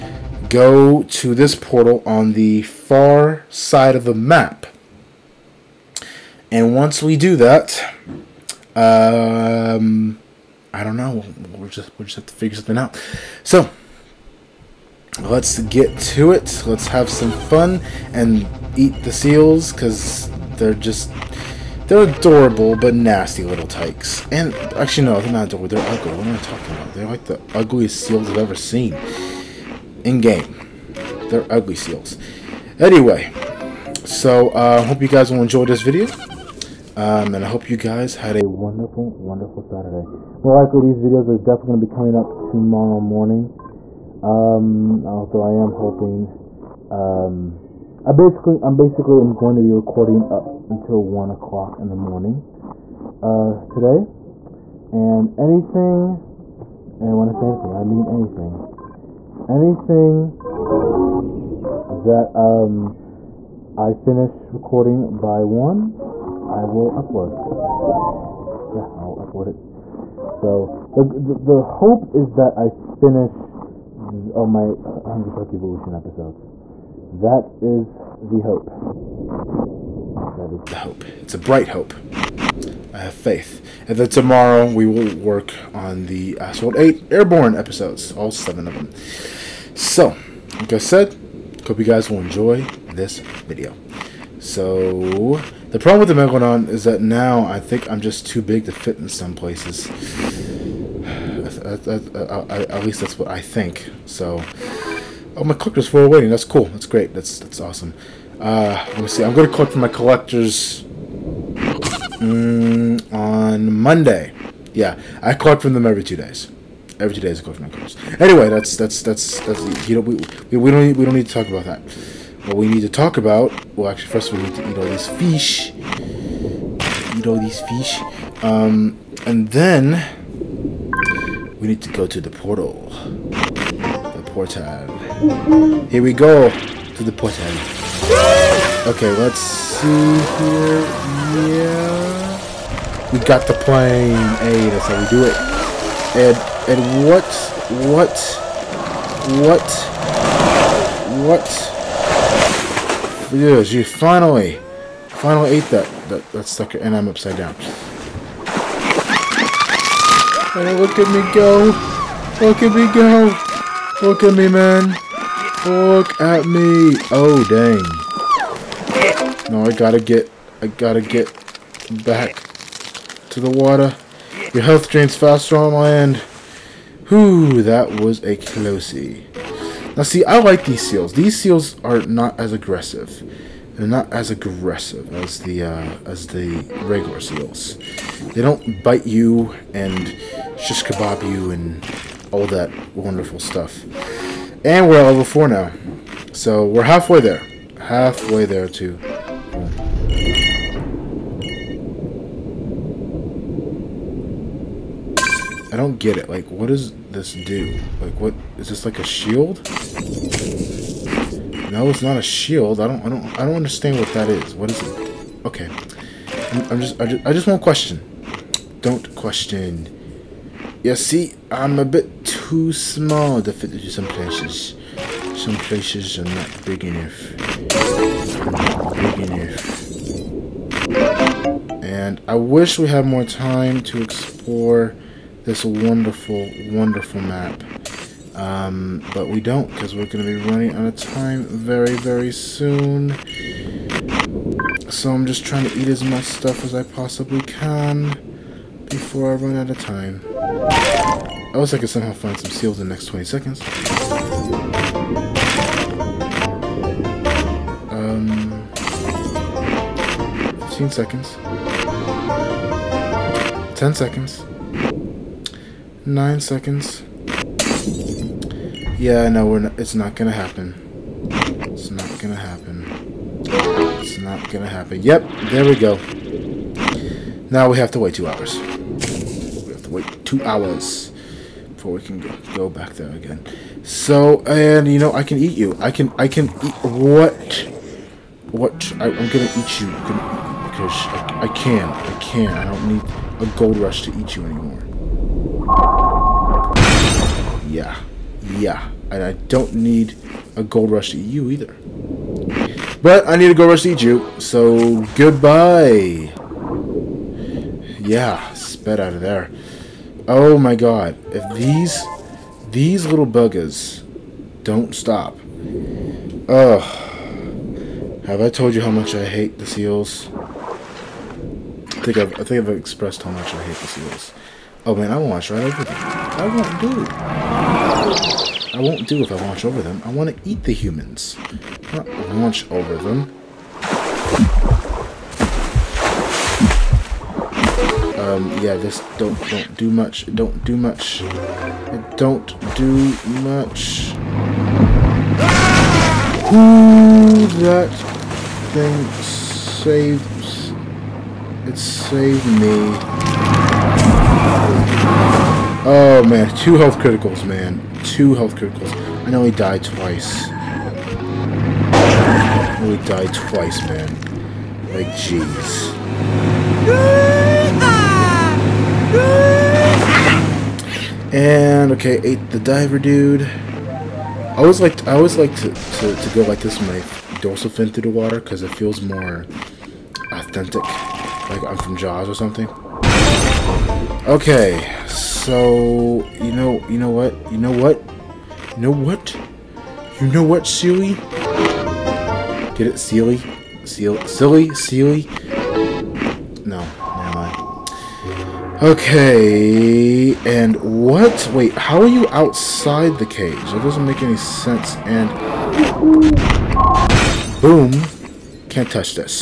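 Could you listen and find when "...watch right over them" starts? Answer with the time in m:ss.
5:25.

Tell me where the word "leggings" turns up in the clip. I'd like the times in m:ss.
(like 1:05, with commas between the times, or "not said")
not said.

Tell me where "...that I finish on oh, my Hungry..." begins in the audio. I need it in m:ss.
1:12.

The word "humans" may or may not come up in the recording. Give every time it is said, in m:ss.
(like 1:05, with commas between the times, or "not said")
5:30.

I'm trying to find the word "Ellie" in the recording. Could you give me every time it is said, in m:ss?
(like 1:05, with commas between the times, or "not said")
not said.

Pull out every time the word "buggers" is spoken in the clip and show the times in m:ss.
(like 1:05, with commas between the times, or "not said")
5:13.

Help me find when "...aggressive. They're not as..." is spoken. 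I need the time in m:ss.
3:02.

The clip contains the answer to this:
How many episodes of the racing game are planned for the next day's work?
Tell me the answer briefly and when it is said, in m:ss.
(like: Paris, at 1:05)
7, at 1:28.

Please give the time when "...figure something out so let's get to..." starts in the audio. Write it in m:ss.
0:12.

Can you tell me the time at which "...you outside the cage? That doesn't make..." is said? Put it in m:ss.
6:42.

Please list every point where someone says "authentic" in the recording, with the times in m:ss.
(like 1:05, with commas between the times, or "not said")
6:20.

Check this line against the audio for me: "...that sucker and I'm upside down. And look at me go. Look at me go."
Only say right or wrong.
right.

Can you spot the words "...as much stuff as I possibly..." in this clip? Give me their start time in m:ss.
4:05.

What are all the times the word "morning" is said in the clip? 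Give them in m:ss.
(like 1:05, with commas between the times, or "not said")
0:42, 0:51.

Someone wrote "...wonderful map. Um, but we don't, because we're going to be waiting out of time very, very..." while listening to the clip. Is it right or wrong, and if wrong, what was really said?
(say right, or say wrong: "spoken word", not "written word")
wrong: "running", not "waiting".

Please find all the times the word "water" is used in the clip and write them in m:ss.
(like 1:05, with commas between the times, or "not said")
2:53, 6:18.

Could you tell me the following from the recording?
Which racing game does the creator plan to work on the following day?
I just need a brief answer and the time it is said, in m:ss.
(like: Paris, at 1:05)
Asphalt 8 Airborne, at 1:26.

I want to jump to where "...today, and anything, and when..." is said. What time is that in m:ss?
0:53.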